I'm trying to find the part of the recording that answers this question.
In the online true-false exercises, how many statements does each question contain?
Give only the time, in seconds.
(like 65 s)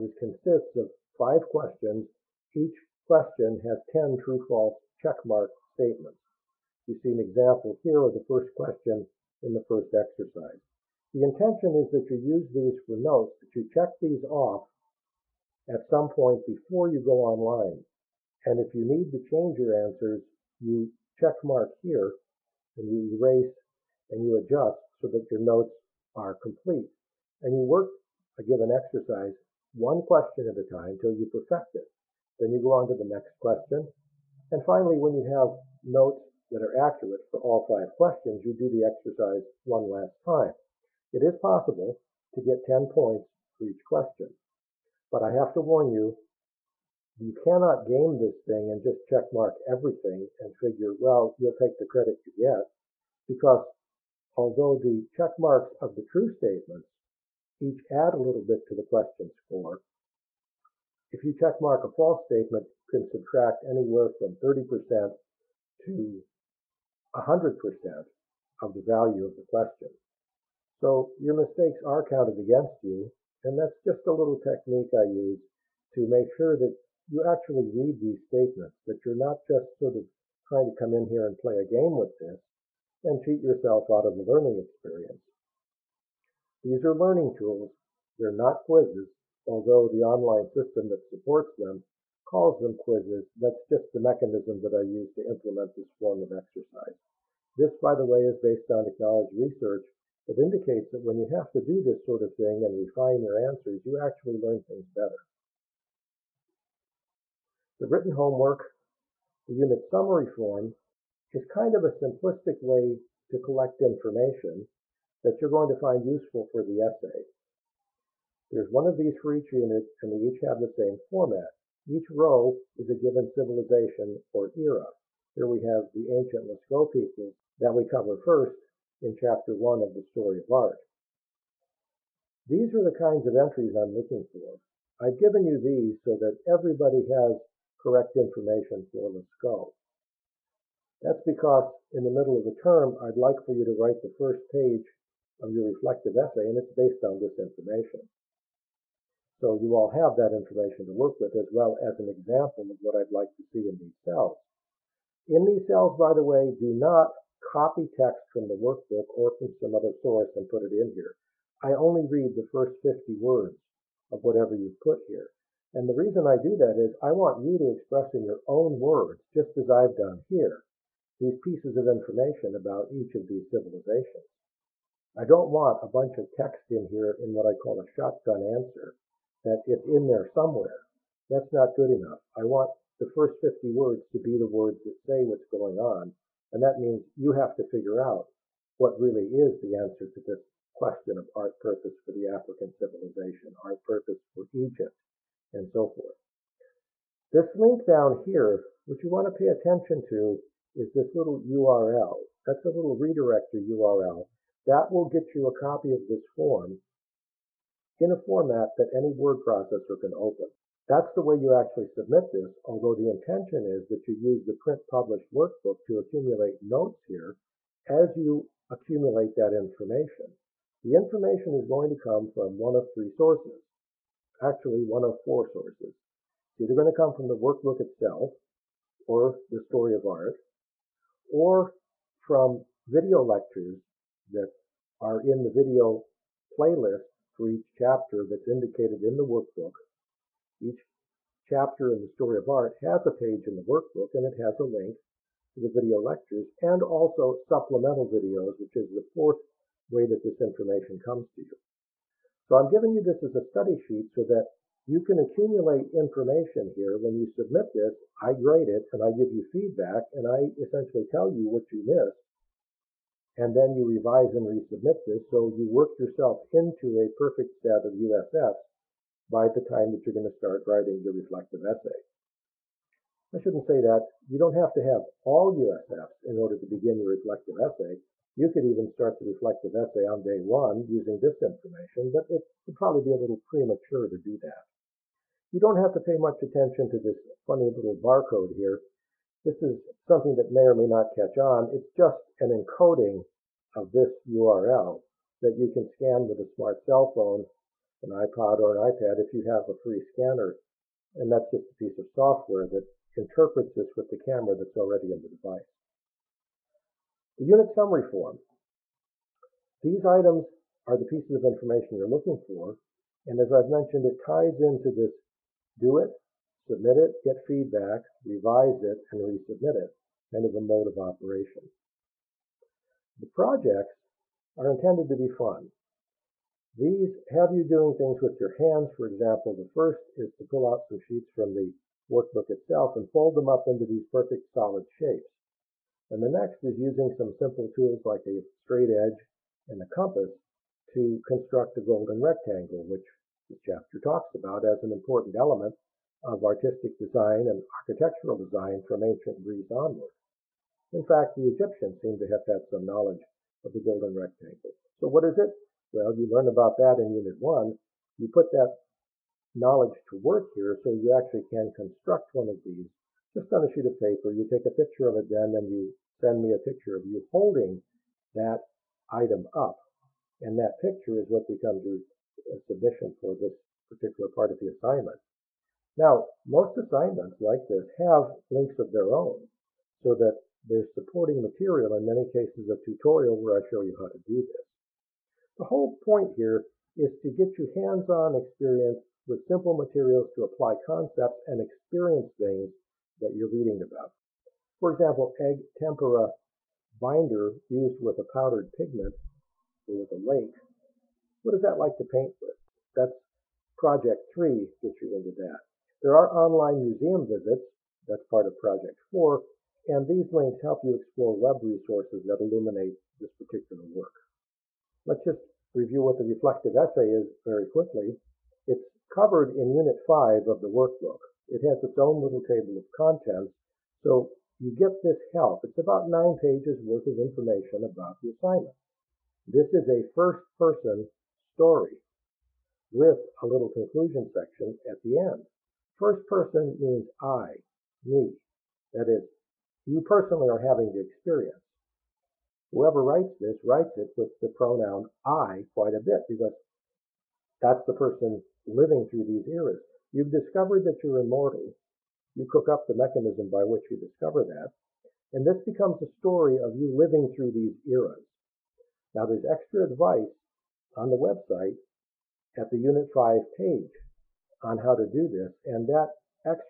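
3 s.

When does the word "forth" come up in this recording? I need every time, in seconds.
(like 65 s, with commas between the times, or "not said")
195 s.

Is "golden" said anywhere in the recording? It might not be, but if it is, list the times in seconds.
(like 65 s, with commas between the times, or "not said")
341 s, 353 s.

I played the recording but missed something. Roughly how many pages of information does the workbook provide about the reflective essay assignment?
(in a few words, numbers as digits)
9.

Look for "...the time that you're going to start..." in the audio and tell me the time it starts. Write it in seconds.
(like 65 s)
269 s.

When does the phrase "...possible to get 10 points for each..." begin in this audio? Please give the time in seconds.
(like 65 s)
41 s.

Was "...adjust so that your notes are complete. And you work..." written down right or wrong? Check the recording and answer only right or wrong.
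right.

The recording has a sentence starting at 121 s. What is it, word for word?
Each row is a given civilization or era.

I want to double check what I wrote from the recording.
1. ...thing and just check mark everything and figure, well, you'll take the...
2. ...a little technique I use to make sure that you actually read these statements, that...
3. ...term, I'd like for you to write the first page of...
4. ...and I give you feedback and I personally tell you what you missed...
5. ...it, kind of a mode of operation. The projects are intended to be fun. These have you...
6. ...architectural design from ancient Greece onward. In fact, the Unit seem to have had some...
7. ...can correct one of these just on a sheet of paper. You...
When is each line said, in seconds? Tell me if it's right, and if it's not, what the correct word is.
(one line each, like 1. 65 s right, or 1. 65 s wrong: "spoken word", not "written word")
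1. 48 s right
2. 74 s right
3. 142 s right
4. 258 s wrong: "essentially", not "personally"
5. 319 s right
6. 347 s wrong: "Egyptians", not "Unit"
7. 361 s wrong: "construct", not "correct".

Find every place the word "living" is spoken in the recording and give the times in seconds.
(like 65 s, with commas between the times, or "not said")
448 s, 456 s.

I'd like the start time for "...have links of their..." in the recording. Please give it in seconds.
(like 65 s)
377 s.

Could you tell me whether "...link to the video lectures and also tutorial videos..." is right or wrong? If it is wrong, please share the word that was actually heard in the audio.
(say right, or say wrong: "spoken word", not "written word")
wrong: "supplemental", not "tutorial".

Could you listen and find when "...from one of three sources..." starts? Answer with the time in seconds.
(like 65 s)
222 s.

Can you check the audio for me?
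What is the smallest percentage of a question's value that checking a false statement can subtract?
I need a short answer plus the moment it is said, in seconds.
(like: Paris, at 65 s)
30%, at 64 s.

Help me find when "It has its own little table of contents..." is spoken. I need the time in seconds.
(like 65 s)
421 s.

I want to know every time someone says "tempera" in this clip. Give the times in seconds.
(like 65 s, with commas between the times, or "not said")
395 s.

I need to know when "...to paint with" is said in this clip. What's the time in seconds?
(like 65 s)
401 s.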